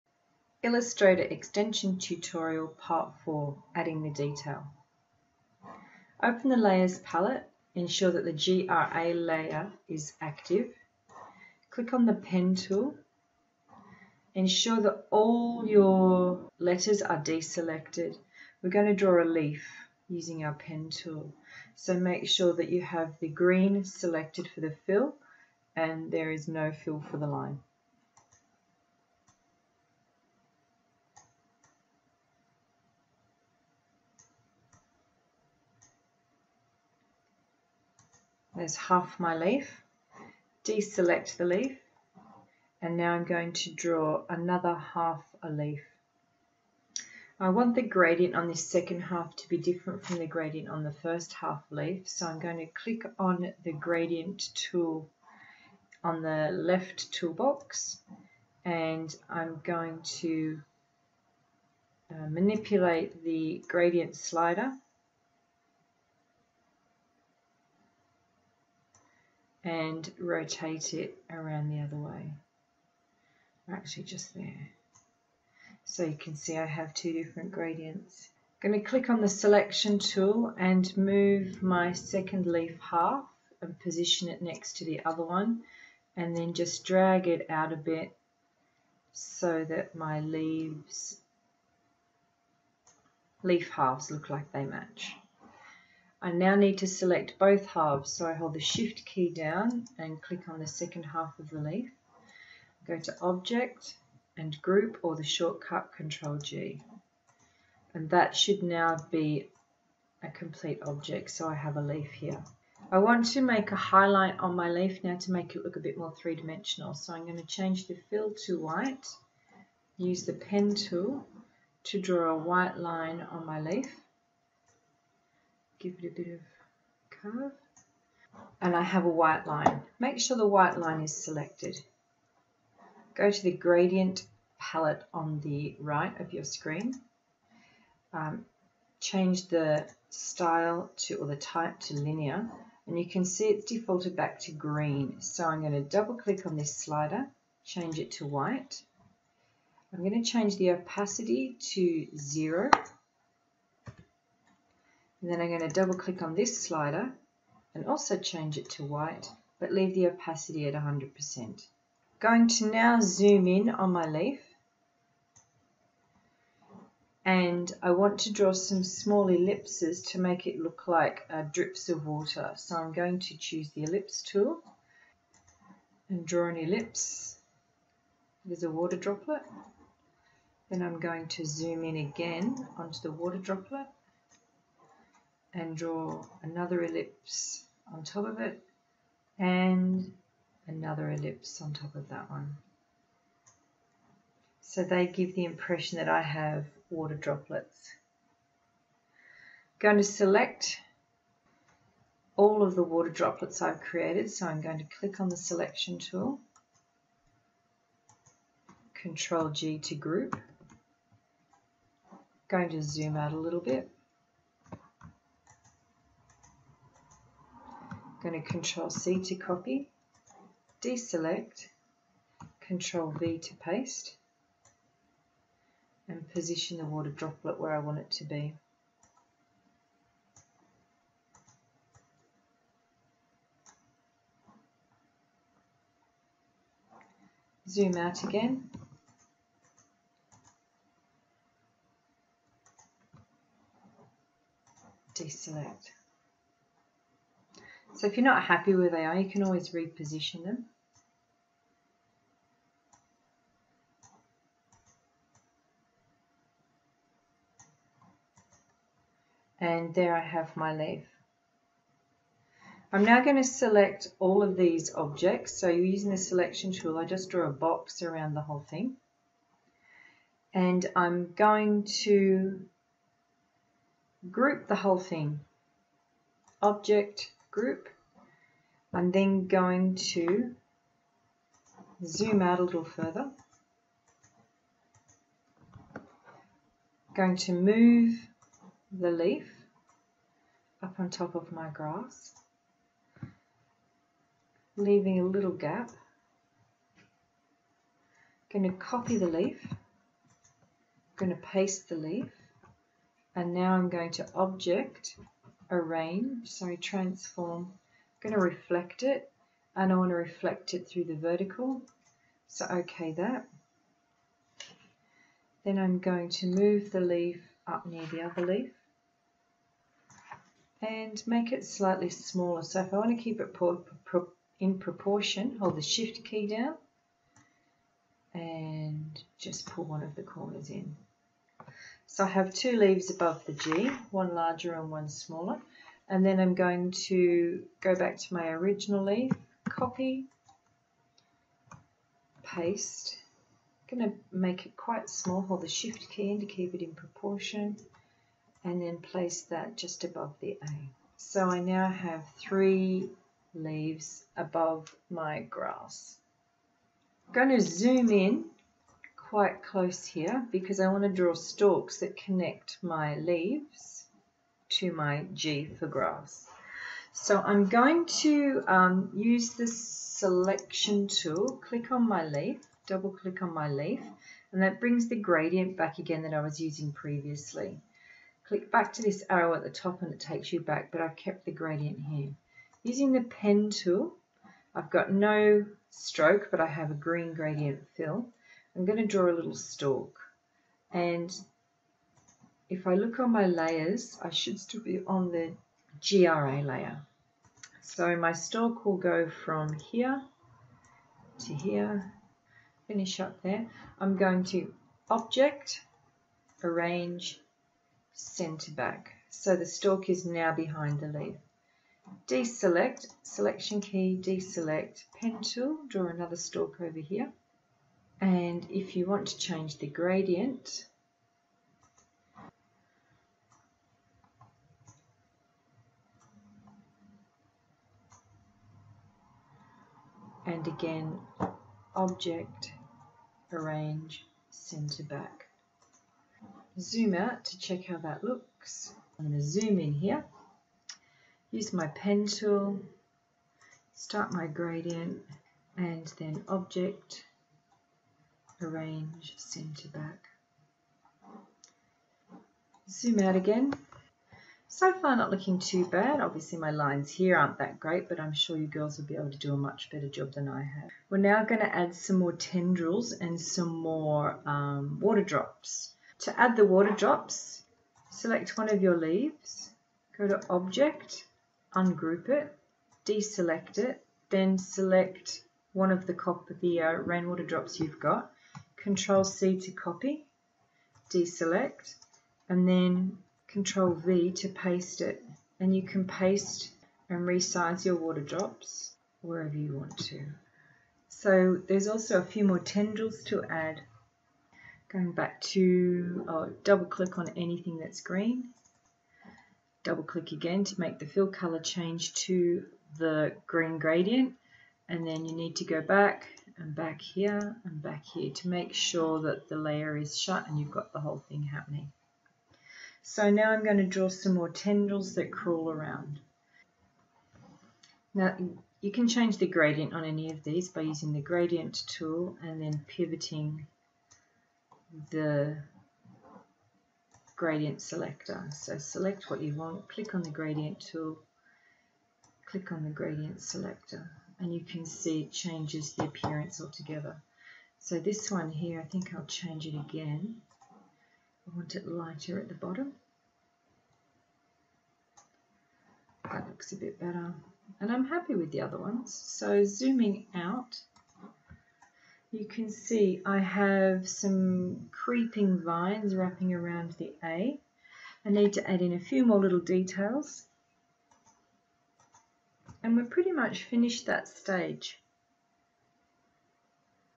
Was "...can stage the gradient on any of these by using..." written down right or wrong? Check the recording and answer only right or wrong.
wrong.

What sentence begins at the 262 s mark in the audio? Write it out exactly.
I'm now going to select all of these objects.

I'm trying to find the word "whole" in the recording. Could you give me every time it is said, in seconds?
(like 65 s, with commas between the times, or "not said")
268 s, 274 s, 511 s.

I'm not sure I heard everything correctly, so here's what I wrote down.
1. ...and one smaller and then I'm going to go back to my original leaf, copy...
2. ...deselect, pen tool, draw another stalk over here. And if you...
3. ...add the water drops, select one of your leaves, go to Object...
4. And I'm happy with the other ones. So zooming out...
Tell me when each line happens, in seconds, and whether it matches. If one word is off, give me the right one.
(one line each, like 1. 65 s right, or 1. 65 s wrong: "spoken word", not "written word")
1. 334 s right
2. 414 s right
3. 466 s right
4. 547 s right.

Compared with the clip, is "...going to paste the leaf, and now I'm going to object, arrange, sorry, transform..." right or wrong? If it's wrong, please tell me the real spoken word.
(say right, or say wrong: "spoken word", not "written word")
right.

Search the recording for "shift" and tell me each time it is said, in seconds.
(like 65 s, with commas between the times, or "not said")
98 s, 325 s, 345 s.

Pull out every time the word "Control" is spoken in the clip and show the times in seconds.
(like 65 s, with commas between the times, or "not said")
105 s, 208 s, 218 s, 222 s, 478 s, 483 s.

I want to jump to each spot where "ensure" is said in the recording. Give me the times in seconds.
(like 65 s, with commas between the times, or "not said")
7 s, 14 s.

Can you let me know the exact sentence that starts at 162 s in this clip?
Going to now zoom in on my leaf.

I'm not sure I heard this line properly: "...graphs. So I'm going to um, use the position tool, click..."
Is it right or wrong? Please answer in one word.
wrong.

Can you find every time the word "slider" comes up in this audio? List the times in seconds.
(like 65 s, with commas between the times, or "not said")
64 s, 146 s, 156 s.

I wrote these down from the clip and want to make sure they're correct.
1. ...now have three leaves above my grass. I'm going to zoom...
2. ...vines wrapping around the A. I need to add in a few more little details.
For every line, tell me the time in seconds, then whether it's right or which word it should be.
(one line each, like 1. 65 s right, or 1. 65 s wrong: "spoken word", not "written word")
1. 351 s right
2. 555 s right.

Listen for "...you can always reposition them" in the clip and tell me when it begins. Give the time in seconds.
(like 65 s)
249 s.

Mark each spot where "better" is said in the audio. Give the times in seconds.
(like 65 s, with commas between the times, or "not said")
459 s, 546 s.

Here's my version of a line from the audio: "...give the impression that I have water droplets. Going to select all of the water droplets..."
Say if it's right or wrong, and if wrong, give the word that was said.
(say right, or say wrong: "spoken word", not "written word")
right.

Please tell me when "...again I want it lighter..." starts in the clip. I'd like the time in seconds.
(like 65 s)
539 s.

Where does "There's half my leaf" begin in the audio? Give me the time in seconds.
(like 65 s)
38 s.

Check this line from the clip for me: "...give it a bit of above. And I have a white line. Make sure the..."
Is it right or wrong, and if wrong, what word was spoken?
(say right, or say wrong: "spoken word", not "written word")
wrong: "curve", not "above".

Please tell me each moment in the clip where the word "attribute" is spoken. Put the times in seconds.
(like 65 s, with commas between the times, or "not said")
not said.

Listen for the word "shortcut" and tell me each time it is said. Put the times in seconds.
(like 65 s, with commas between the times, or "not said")
105 s.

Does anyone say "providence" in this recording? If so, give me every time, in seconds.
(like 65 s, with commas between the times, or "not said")
not said.